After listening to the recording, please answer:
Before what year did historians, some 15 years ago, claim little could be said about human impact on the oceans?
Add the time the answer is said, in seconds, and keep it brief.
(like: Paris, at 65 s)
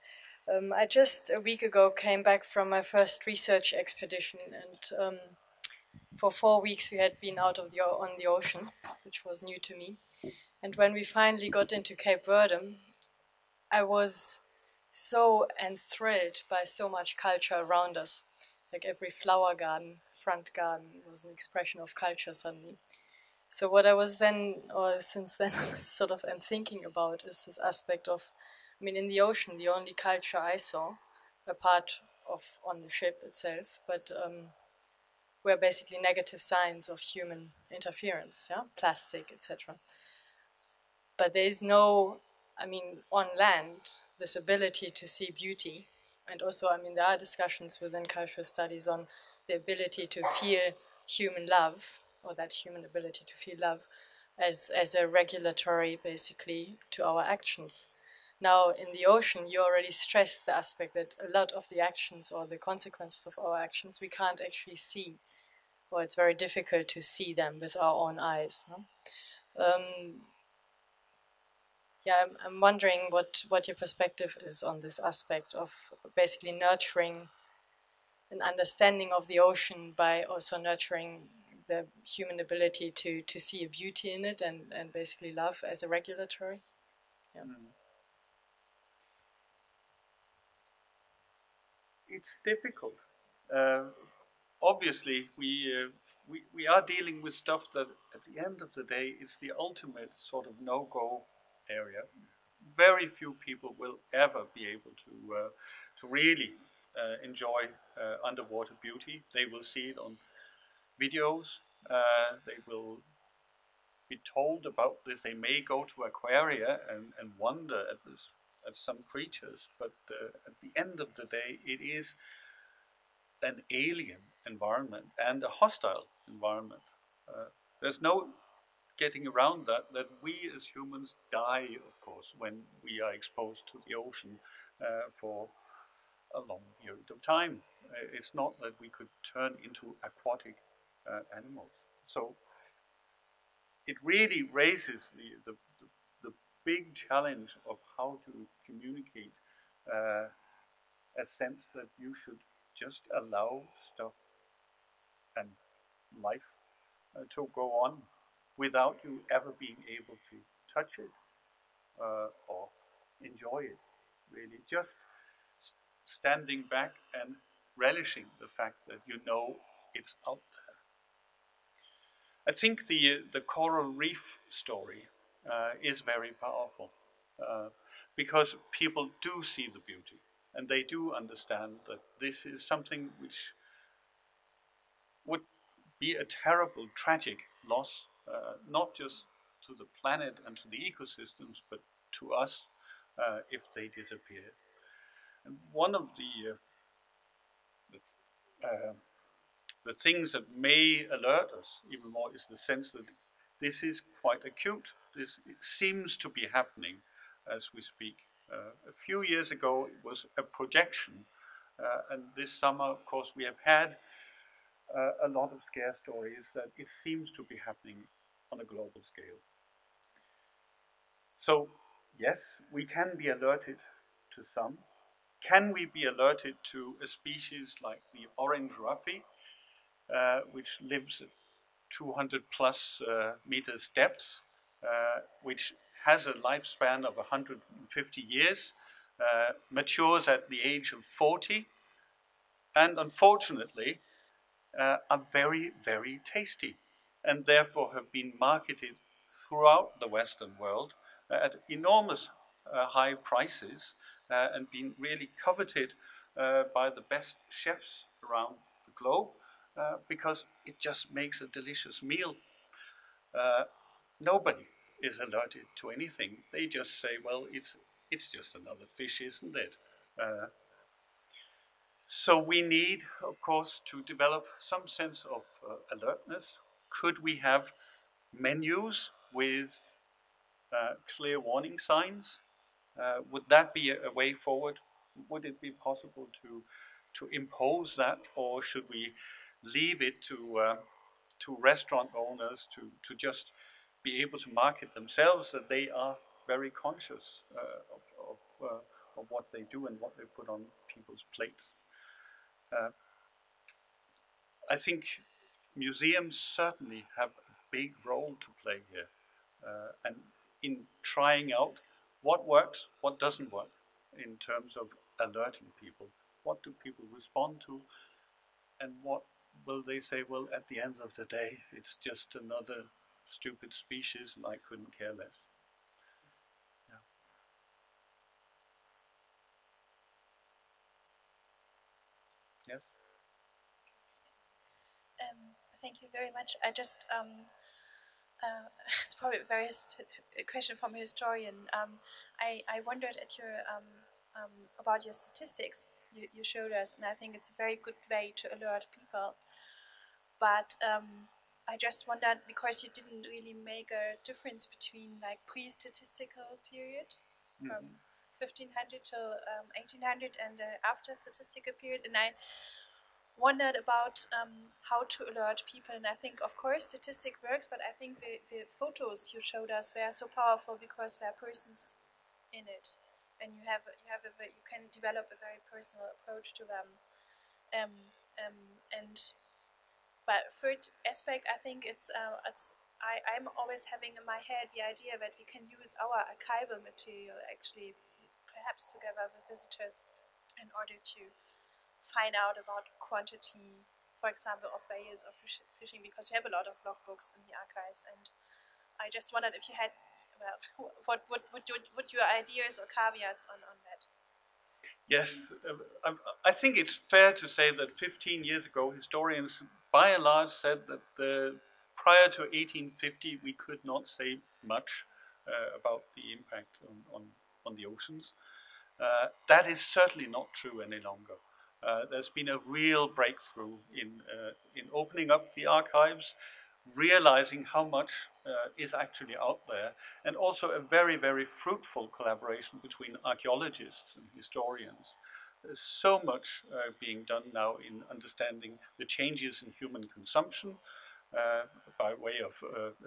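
1850, at 412 s.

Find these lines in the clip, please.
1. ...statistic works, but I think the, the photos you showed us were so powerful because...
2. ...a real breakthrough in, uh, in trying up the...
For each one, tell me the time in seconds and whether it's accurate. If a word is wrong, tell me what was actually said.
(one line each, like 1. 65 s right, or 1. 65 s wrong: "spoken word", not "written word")
1. 366 s right
2. 422 s wrong: "opening", not "trying".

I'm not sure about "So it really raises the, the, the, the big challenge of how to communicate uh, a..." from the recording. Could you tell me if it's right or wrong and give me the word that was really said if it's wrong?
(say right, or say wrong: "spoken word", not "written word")
right.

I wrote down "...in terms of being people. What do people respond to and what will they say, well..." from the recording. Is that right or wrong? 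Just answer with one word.
wrong.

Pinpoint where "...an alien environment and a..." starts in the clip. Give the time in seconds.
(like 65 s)
123 s.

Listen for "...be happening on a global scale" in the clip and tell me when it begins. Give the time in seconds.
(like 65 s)
217 s.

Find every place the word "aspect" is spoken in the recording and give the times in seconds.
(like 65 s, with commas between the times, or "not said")
27 s, 60 s, 74 s, 381 s.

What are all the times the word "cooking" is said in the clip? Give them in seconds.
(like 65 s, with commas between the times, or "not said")
not said.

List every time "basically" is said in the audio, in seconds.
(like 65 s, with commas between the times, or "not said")
35 s, 56 s, 76 s, 84 s.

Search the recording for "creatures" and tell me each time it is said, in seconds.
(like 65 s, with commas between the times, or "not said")
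119 s.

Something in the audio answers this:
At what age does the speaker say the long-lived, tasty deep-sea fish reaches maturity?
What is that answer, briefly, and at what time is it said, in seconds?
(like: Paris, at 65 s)
40, at 240 s.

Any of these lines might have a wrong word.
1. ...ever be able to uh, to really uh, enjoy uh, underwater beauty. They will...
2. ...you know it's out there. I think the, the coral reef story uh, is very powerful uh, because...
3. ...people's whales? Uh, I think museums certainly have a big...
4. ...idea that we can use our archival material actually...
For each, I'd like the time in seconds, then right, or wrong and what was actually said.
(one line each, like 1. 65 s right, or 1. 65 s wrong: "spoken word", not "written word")
1. 104 s right
2. 169 s right
3. 300 s wrong: "plates", not "whales"
4. 384 s right.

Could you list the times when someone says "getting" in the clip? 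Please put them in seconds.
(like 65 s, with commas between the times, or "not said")
128 s.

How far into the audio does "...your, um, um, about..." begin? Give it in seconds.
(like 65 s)
343 s.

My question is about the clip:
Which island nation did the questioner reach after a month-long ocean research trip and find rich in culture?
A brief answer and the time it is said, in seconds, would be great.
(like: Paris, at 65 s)
Cape Verde, at 11 s.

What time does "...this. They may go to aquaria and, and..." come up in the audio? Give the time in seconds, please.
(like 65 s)
115 s.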